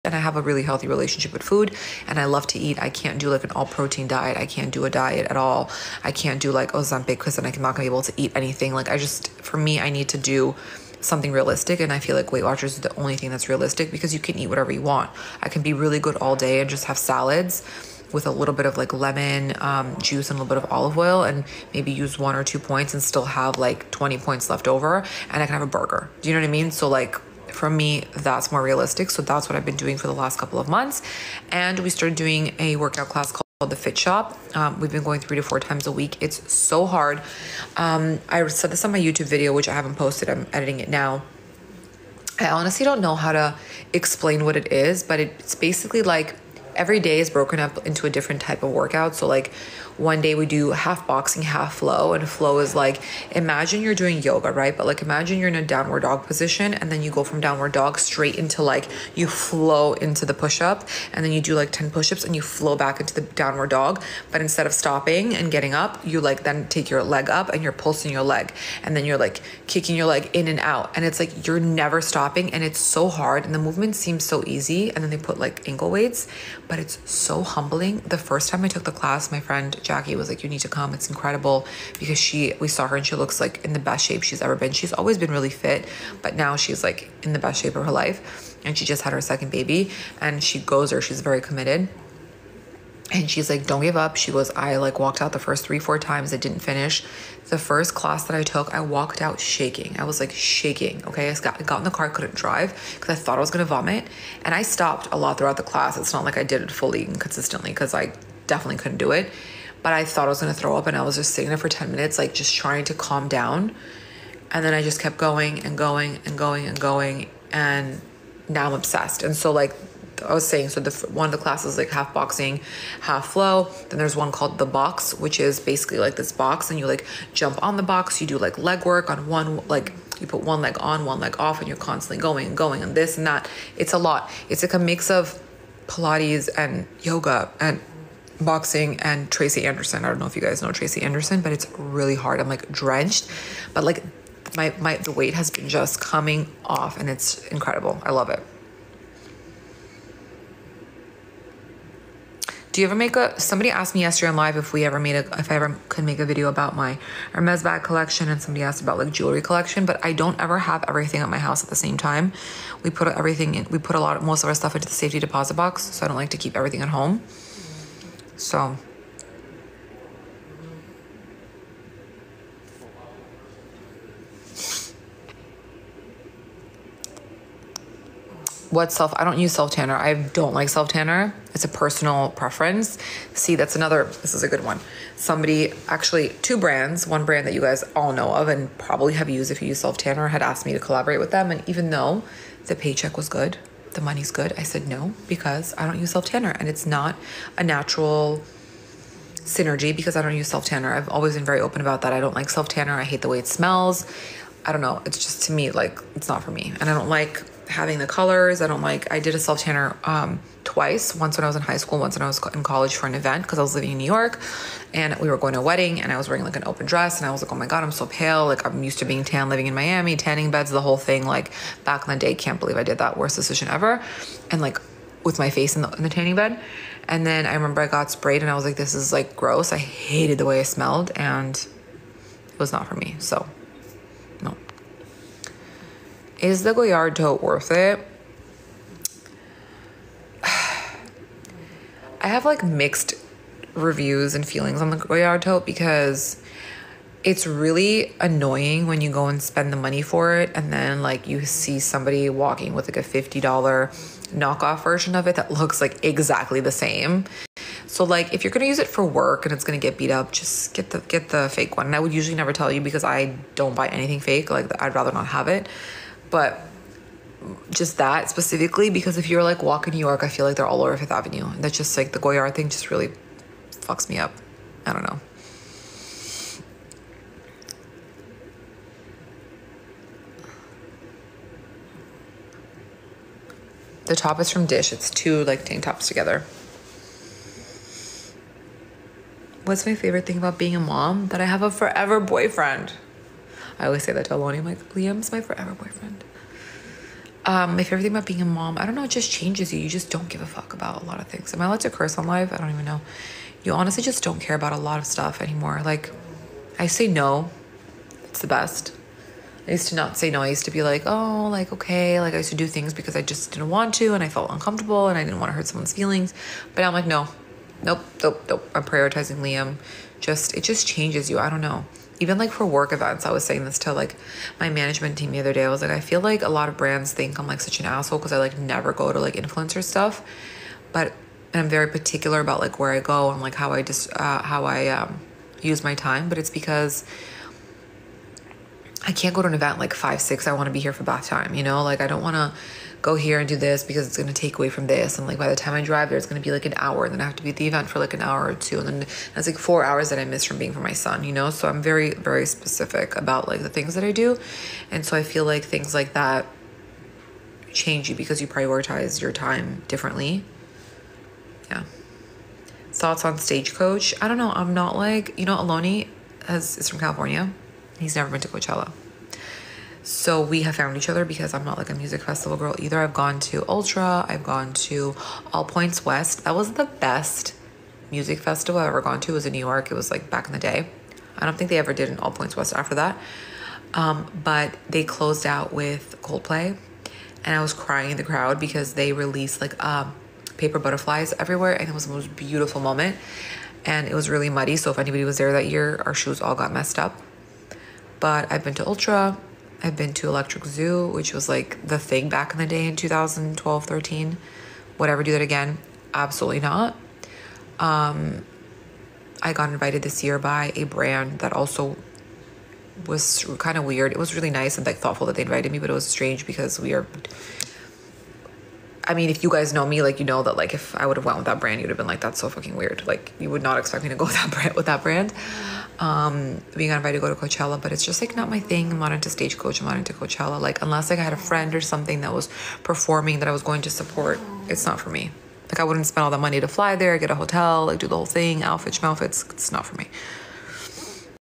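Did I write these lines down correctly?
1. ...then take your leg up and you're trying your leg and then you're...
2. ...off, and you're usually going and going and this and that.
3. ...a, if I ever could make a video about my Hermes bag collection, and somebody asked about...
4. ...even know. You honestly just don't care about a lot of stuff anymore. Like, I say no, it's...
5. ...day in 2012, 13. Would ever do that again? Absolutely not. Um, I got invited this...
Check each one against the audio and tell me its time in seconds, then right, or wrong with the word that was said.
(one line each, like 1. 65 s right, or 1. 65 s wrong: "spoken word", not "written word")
1. 66 s wrong: "pulsing", not "trying"
2. 131 s wrong: "constantly", not "usually"
3. 155 s right
4. 302 s right
5. 402 s right.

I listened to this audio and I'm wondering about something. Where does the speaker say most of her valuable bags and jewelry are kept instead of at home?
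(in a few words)
Safety deposit box.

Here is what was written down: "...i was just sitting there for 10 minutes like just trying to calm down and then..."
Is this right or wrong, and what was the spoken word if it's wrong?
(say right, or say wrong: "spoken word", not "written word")
right.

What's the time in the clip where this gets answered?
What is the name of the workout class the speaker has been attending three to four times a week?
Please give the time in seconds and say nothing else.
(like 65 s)
33 s.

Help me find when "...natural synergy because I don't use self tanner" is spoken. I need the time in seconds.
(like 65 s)
197 s.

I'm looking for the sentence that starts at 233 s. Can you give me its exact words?
So is the Goyard tote worth it?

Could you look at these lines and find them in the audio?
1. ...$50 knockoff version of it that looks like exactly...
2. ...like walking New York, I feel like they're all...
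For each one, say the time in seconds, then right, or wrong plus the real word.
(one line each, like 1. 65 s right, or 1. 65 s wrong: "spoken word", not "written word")
1. 253 s right
2. 269 s right.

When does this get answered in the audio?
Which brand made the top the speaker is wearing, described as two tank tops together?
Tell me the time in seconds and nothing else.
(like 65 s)
284 s.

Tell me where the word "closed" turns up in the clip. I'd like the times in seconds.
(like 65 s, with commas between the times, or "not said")
385 s.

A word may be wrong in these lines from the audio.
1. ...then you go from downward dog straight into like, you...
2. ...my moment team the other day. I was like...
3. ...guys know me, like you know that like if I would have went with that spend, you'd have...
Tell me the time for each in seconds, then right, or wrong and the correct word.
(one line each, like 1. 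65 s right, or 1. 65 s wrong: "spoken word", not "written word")
1. 56 s right
2. 324 s wrong: "management", not "moment"
3. 419 s wrong: "brand", not "spend".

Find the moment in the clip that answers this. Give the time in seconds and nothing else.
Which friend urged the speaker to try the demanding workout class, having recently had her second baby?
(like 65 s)
79 s.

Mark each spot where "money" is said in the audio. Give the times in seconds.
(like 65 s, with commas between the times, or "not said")
194 s, 249 s, 436 s.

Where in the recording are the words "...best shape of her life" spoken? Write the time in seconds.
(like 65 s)
87 s.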